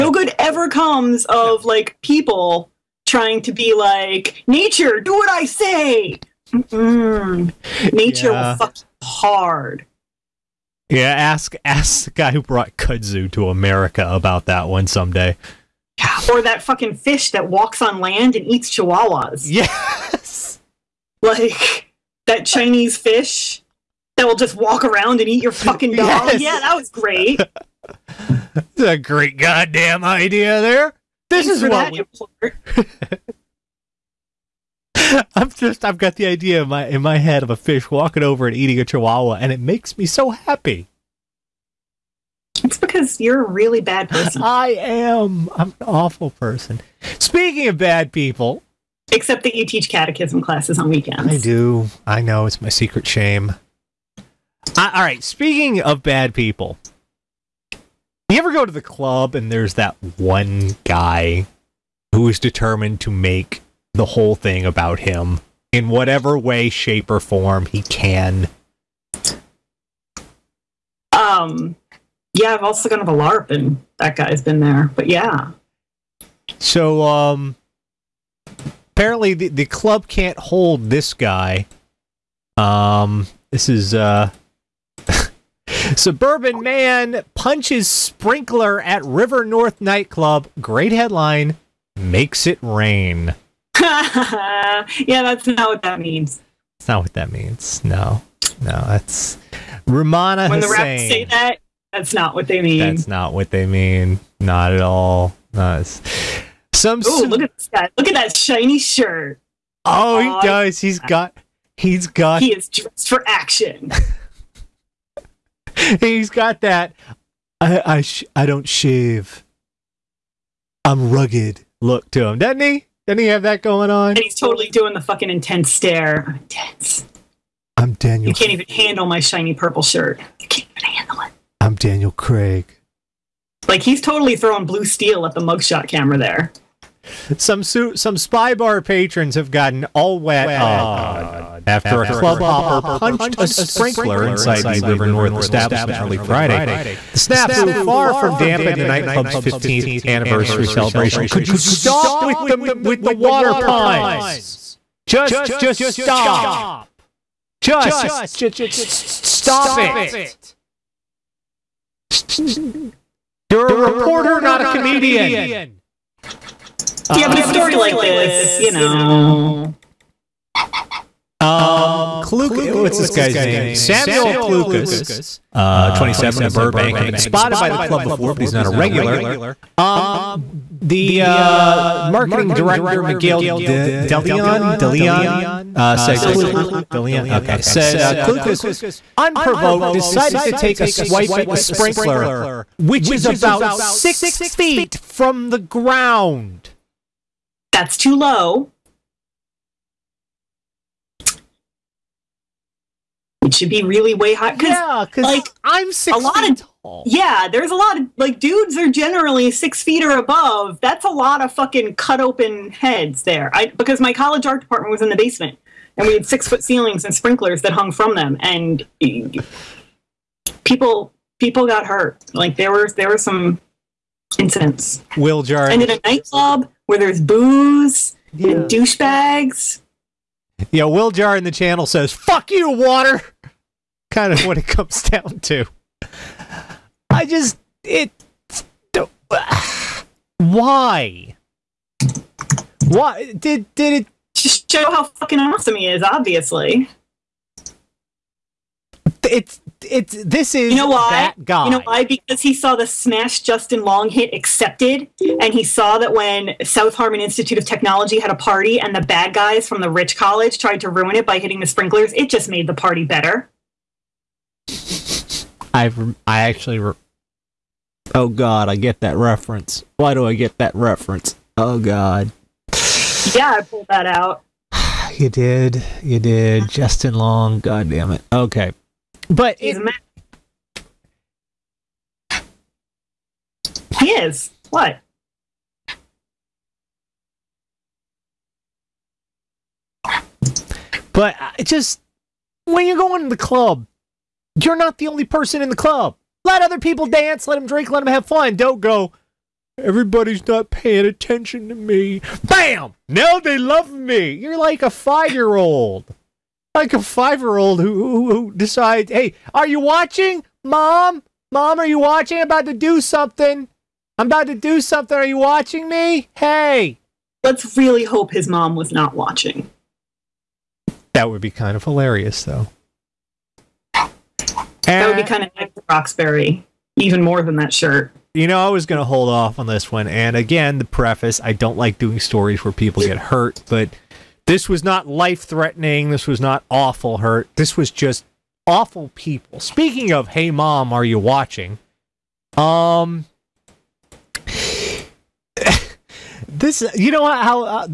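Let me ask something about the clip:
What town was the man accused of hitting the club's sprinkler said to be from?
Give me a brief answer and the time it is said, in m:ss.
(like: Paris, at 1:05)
Burbank, at 2:56.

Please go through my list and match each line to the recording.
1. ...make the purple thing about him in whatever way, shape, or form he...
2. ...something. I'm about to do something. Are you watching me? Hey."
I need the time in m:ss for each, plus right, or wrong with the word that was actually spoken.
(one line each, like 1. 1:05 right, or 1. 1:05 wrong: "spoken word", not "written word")
1. 1:03 wrong: "whole", not "purple"
2. 5:13 right.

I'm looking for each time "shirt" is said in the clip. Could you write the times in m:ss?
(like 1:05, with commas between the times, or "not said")
1:48, 2:09, 5:27.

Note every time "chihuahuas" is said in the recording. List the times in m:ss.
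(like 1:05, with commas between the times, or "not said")
0:18, 0:38.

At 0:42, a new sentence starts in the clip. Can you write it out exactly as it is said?
It's because you're a really bad person.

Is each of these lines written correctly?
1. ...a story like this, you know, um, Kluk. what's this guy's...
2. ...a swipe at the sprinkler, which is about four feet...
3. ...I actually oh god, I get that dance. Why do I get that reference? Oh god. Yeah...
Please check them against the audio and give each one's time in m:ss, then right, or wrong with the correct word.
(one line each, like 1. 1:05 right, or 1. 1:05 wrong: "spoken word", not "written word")
1. 2:47 right
2. 3:10 wrong: "six", not "four"
3. 4:26 wrong: "reference", not "dance".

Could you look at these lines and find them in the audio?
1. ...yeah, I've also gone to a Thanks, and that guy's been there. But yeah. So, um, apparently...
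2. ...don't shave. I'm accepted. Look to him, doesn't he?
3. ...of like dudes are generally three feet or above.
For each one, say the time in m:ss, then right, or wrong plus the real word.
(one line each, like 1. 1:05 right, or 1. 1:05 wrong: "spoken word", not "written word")
1. 1:12 wrong: "LARP", not "Thanks"
2. 1:58 wrong: "rugged", not "accepted"
3. 3:28 wrong: "six", not "three".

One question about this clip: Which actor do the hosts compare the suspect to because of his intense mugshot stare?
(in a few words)
Daniel Craig.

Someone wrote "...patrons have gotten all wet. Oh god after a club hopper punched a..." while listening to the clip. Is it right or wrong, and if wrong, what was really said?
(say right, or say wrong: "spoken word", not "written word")
right.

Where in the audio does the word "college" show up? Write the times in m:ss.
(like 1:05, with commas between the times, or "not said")
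3:34, 4:20.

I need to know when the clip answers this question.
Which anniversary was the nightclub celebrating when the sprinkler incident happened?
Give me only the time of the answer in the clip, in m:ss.
2:29.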